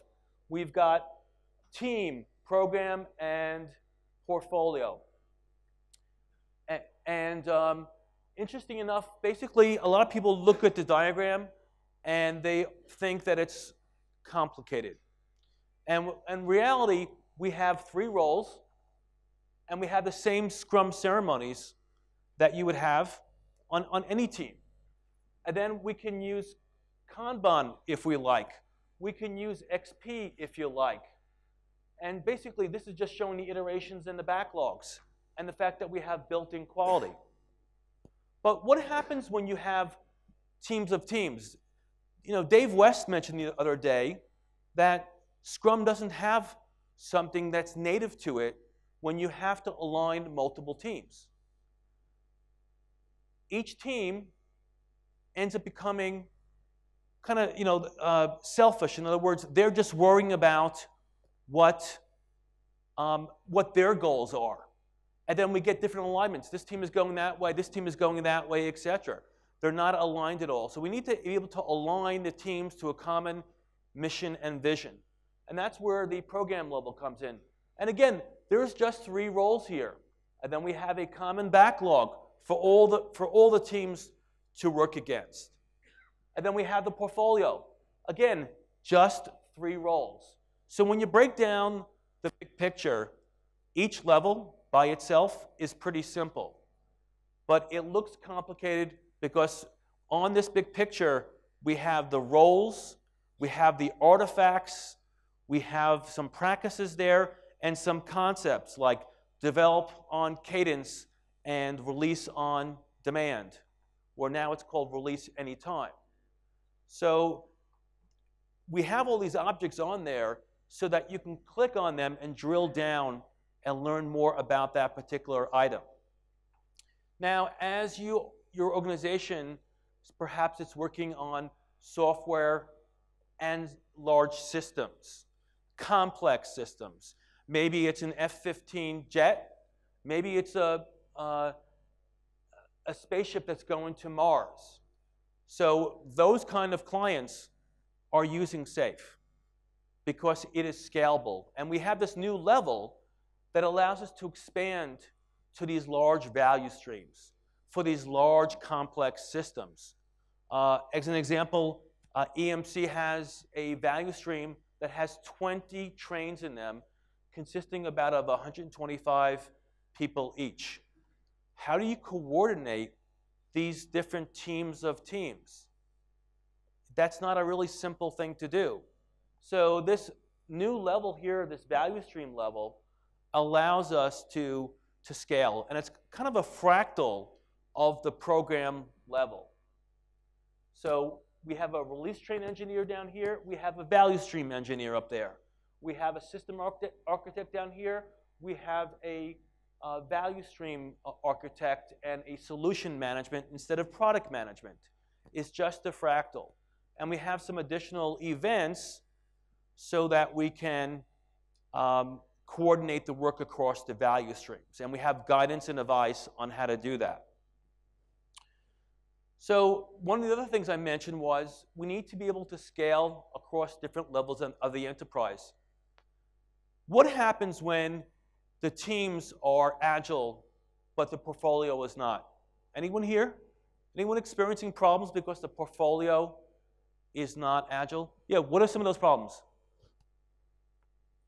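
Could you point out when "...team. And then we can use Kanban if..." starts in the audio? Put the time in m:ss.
0:24.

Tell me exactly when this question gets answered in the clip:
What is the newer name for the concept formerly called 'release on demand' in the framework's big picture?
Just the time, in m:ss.
1:54.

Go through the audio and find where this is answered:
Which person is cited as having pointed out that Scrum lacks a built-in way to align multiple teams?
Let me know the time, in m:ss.
0:42.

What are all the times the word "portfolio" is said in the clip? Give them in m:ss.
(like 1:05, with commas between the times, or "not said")
0:04, 1:26, 3:51, 3:55.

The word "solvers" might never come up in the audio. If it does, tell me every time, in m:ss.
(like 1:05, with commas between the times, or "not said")
not said.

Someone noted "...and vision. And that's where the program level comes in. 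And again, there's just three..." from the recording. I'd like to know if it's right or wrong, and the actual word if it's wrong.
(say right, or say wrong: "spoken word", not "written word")
right.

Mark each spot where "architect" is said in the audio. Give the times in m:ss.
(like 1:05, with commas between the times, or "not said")
3:17, 3:21.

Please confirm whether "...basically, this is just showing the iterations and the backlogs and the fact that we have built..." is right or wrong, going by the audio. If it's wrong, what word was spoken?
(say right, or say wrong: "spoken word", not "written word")
right.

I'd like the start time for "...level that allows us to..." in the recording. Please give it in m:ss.
2:32.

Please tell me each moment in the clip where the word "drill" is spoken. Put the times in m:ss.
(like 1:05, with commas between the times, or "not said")
2:02.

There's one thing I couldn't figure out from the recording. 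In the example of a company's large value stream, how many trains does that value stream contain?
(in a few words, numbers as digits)
20.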